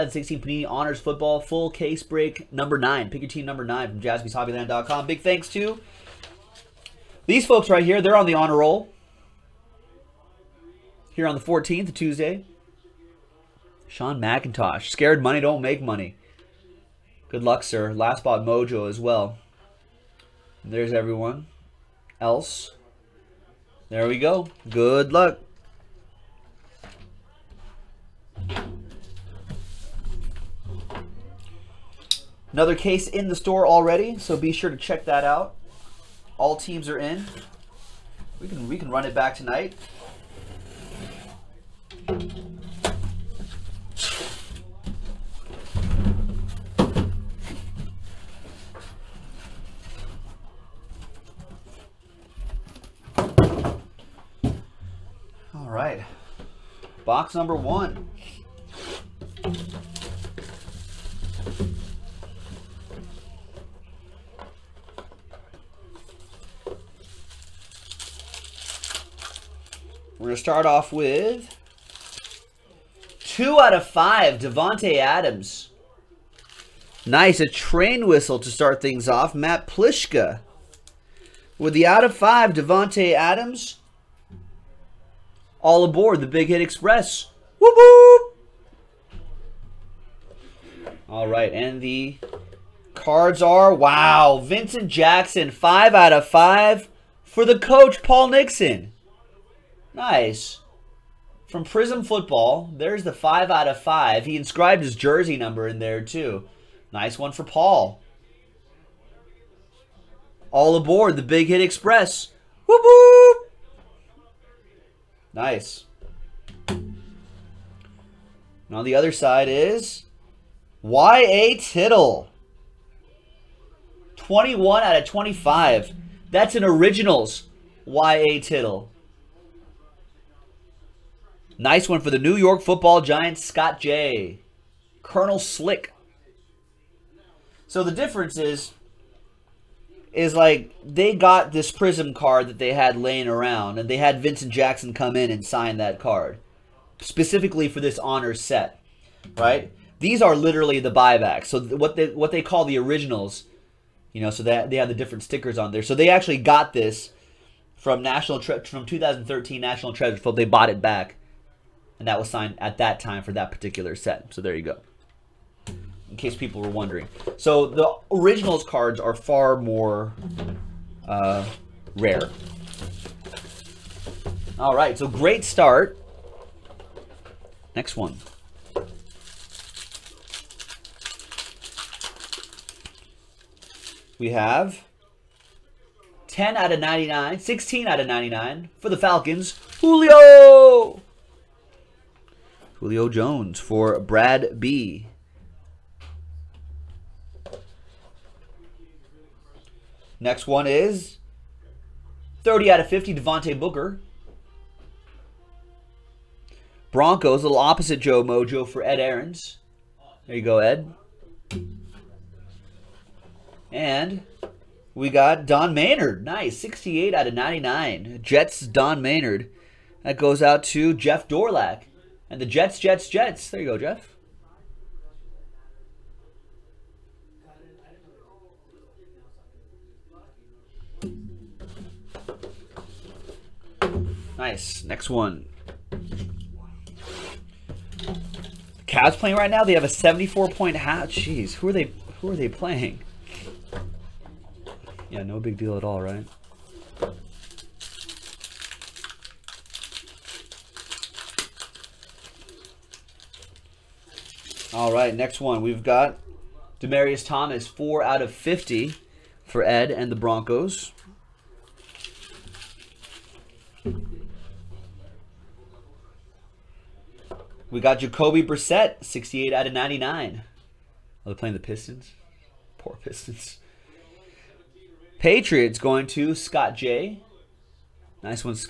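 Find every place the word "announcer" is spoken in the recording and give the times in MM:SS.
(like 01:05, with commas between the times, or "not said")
not said.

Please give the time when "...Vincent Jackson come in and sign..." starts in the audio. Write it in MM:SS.
02:24.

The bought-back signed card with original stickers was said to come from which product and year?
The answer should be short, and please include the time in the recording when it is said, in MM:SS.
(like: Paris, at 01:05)
2013 National Treasure, at 02:38.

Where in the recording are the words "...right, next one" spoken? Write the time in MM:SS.
04:14.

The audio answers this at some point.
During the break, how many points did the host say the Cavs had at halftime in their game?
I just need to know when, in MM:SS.
03:59.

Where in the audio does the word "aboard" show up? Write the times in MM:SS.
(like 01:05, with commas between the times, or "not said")
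01:25, 01:50.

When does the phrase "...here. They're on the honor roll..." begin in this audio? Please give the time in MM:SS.
00:07.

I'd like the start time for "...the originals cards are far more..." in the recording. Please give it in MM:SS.
02:47.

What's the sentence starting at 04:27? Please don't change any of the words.
We got Jacoby Brissett, 68 out of 99.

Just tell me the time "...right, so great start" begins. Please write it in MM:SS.
02:54.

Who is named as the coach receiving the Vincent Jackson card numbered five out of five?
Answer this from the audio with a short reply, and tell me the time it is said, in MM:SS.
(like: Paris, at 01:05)
Paul Nixon, at 01:38.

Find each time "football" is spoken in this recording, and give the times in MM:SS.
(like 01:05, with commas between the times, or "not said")
00:00, 01:42, 02:12.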